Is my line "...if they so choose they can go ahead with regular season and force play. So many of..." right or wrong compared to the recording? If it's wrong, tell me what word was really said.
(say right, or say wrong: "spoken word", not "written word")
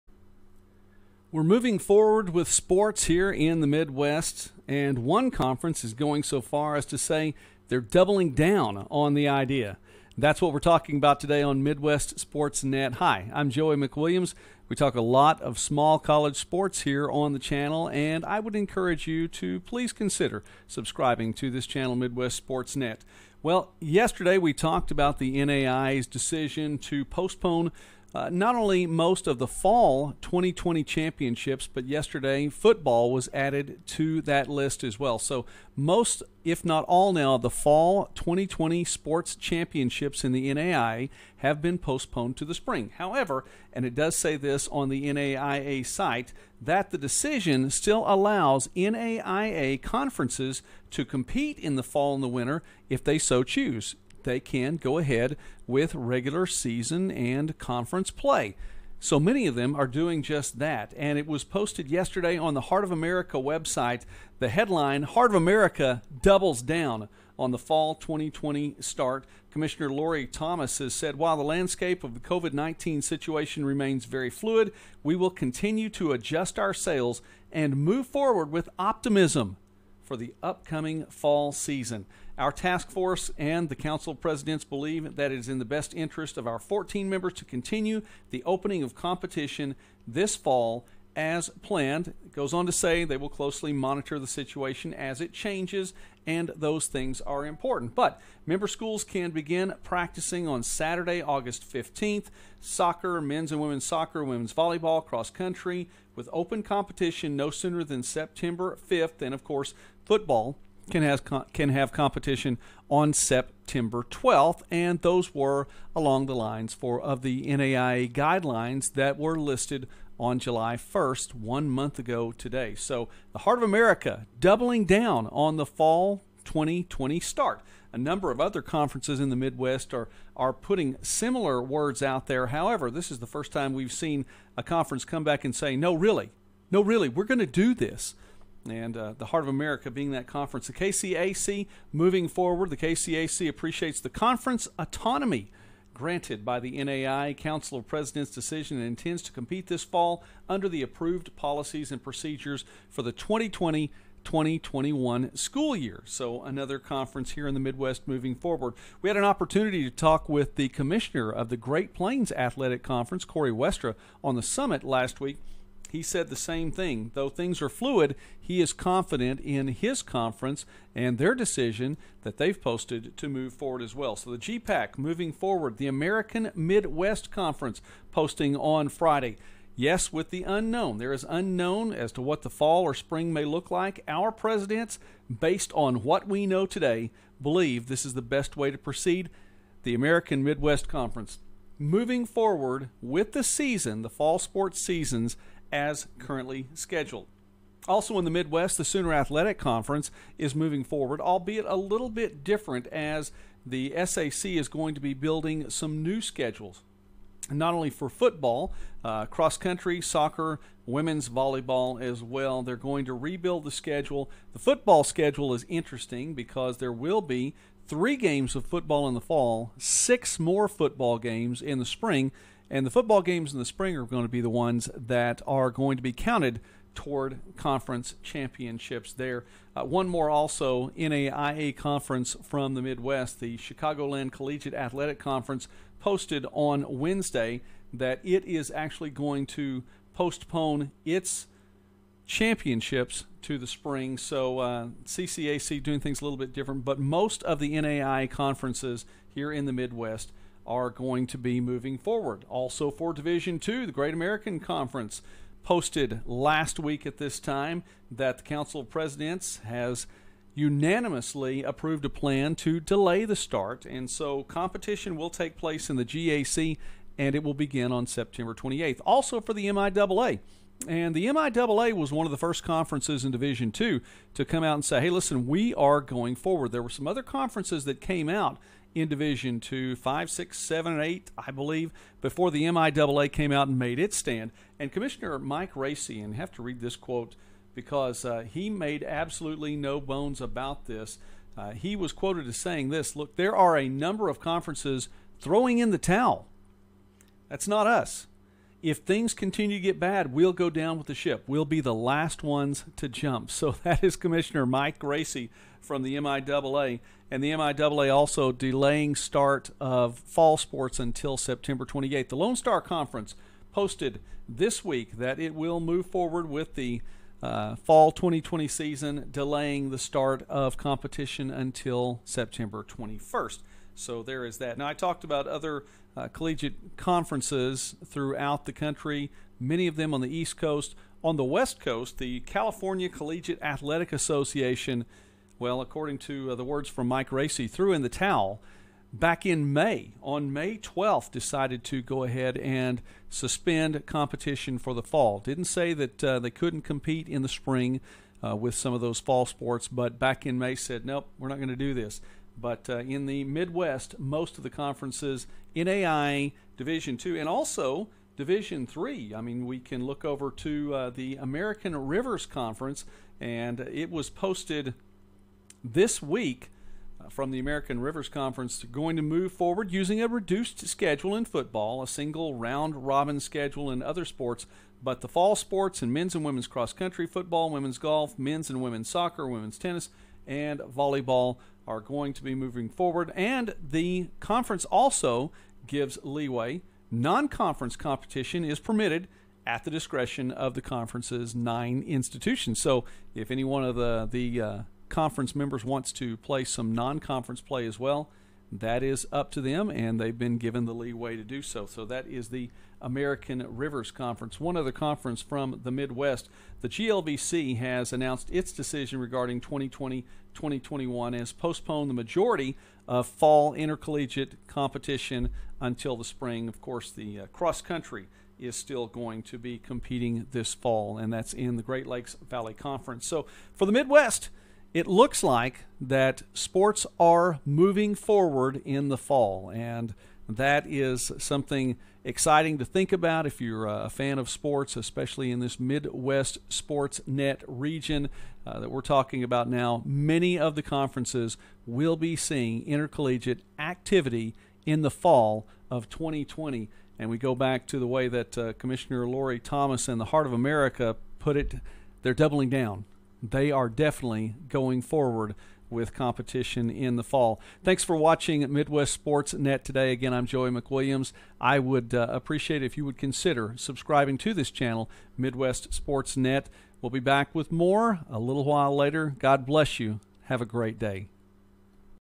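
wrong: "conference", not "force".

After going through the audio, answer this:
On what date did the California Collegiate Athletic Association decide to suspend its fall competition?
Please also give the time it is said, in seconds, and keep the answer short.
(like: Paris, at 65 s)
May 12th, at 340 s.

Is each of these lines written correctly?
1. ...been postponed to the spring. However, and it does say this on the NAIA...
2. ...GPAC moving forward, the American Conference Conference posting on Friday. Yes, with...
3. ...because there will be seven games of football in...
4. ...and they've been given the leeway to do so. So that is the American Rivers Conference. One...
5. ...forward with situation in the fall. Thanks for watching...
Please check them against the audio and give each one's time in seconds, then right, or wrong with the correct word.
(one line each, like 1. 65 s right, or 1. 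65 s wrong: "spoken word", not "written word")
1. 41 s right
2. 174 s wrong: "Midwest", not "Conference"
3. 216 s wrong: "three", not "seven"
4. 399 s right
5. 455 s wrong: "competition", not "situation".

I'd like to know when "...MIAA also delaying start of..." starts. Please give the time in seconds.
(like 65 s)
307 s.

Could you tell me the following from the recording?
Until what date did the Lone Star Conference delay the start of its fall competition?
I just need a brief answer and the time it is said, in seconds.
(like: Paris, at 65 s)
September 21st, at 322 s.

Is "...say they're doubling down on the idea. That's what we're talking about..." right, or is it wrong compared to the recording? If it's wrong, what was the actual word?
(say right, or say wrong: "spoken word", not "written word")
right.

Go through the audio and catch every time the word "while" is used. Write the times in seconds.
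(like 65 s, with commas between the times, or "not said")
71 s, 468 s.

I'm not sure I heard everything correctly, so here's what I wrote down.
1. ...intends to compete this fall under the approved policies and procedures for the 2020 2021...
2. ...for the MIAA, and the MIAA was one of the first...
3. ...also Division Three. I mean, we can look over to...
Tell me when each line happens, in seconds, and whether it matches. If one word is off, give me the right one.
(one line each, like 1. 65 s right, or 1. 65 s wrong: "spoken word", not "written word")
1. 148 s right
2. 269 s right
3. 357 s right.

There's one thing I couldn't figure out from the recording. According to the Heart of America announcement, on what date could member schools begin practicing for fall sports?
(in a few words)
Saturday, August 15th.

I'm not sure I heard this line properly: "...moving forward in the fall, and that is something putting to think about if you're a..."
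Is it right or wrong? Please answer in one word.
wrong.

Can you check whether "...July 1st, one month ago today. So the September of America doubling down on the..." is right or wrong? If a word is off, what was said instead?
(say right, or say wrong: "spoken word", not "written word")
wrong: "Heart", not "September".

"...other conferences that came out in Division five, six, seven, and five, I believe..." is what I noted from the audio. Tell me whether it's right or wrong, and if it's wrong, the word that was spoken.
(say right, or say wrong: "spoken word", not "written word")
wrong: "eight", not "five".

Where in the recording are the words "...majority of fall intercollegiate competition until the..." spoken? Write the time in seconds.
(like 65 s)
412 s.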